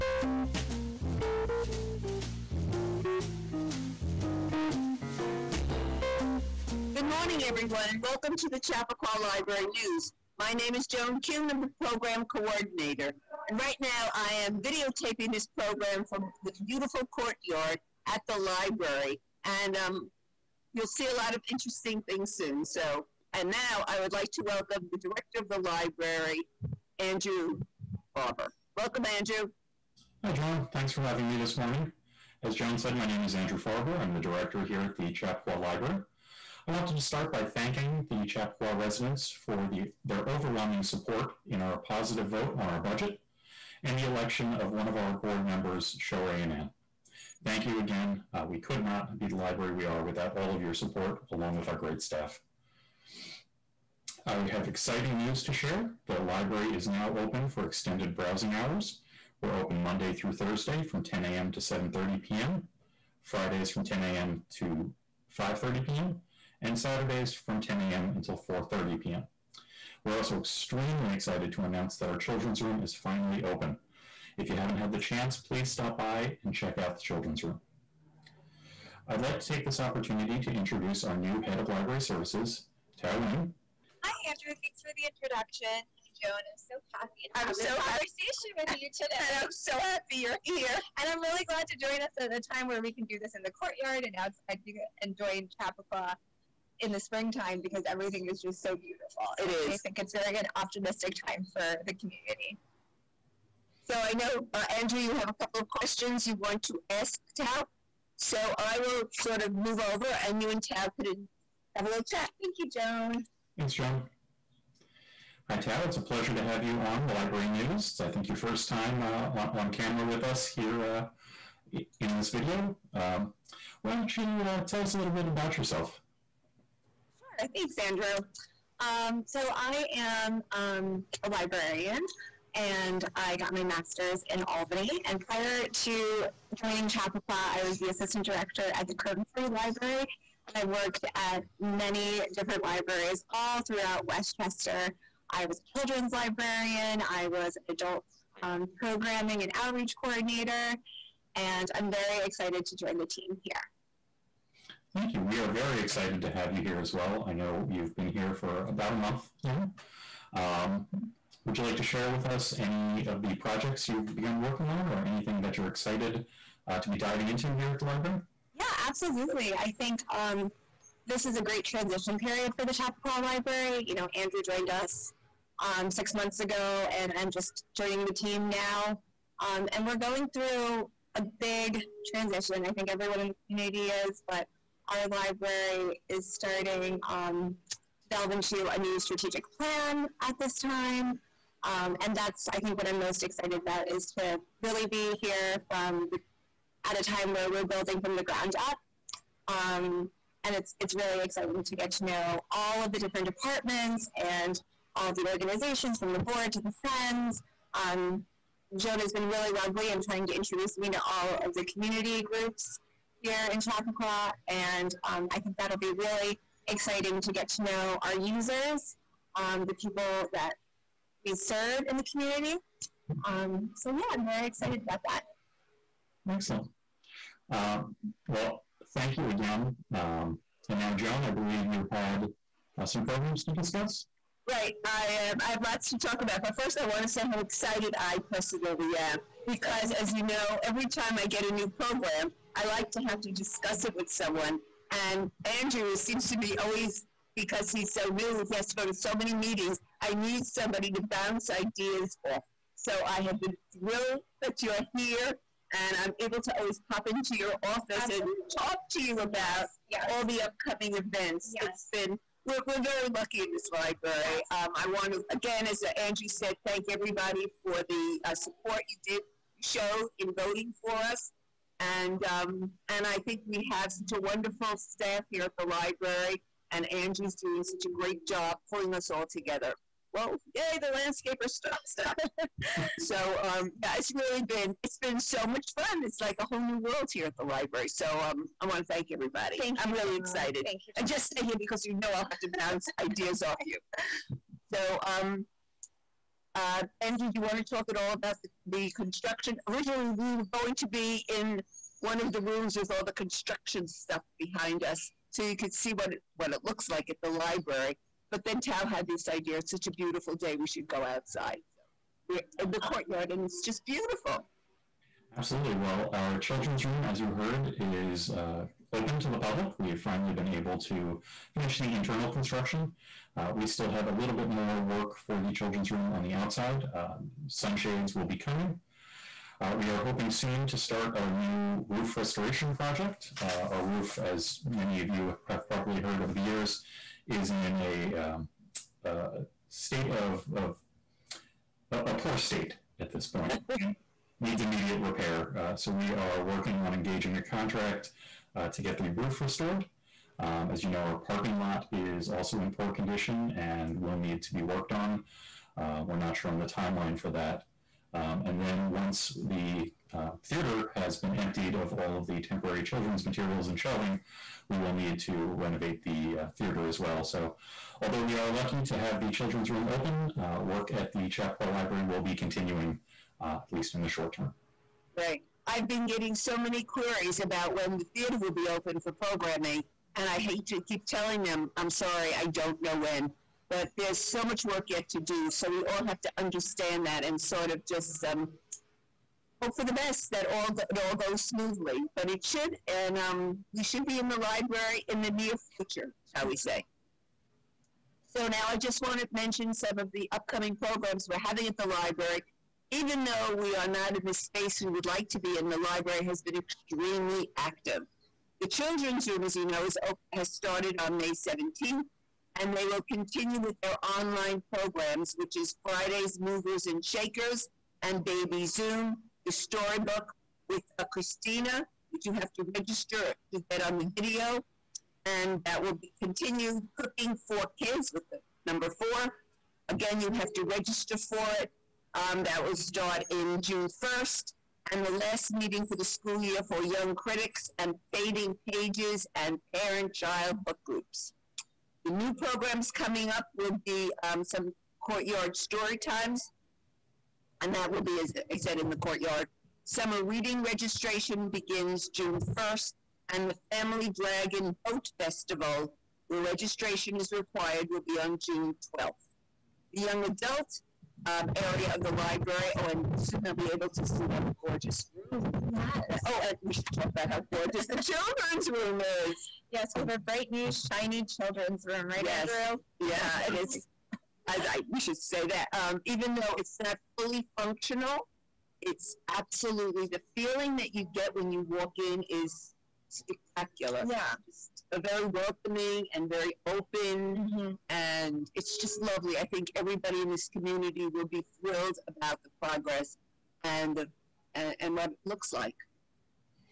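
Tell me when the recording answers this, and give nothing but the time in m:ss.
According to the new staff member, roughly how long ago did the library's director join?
2:55.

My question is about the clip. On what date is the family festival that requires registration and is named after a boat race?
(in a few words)
June 12.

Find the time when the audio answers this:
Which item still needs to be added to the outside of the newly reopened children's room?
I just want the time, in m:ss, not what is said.
5:27.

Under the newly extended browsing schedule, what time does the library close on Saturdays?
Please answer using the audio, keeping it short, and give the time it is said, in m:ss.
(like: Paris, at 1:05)
4:30 p.m., at 1:08.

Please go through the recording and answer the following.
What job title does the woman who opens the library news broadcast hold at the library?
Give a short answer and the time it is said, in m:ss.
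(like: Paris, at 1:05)
Program coordinator, at 0:11.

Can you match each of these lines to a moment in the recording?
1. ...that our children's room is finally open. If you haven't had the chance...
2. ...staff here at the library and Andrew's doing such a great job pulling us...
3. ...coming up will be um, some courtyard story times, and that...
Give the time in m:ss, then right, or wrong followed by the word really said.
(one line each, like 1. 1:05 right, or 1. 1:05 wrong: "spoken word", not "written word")
1. 1:11 right
2. 4:34 right
3. 7:22 right.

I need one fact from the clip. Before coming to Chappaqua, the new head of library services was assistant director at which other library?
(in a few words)
Croton Free Library.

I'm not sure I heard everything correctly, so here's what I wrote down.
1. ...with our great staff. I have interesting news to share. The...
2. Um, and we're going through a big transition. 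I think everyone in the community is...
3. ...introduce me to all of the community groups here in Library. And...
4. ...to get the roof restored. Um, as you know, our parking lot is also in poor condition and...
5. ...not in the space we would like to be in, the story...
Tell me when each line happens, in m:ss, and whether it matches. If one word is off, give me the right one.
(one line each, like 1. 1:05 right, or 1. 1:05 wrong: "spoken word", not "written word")
1. 0:51 wrong: "exciting", not "interesting"
2. 2:59 right
3. 3:30 wrong: "Chappaqua", not "Library"
4. 5:48 right
5. 6:43 wrong: "library", not "story".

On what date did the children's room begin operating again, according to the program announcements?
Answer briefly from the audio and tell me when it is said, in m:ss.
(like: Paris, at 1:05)
May 17, at 6:51.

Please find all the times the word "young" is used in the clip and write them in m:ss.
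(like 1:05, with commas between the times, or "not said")
7:16, 7:40.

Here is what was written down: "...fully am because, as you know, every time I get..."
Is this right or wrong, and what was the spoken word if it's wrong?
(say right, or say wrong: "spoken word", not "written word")
wrong: "personally", not "fully".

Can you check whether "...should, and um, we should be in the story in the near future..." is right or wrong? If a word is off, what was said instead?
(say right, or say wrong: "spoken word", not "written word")
wrong: "library", not "story".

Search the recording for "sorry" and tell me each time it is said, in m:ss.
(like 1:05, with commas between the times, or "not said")
6:21.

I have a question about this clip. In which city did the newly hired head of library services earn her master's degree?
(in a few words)
Albany.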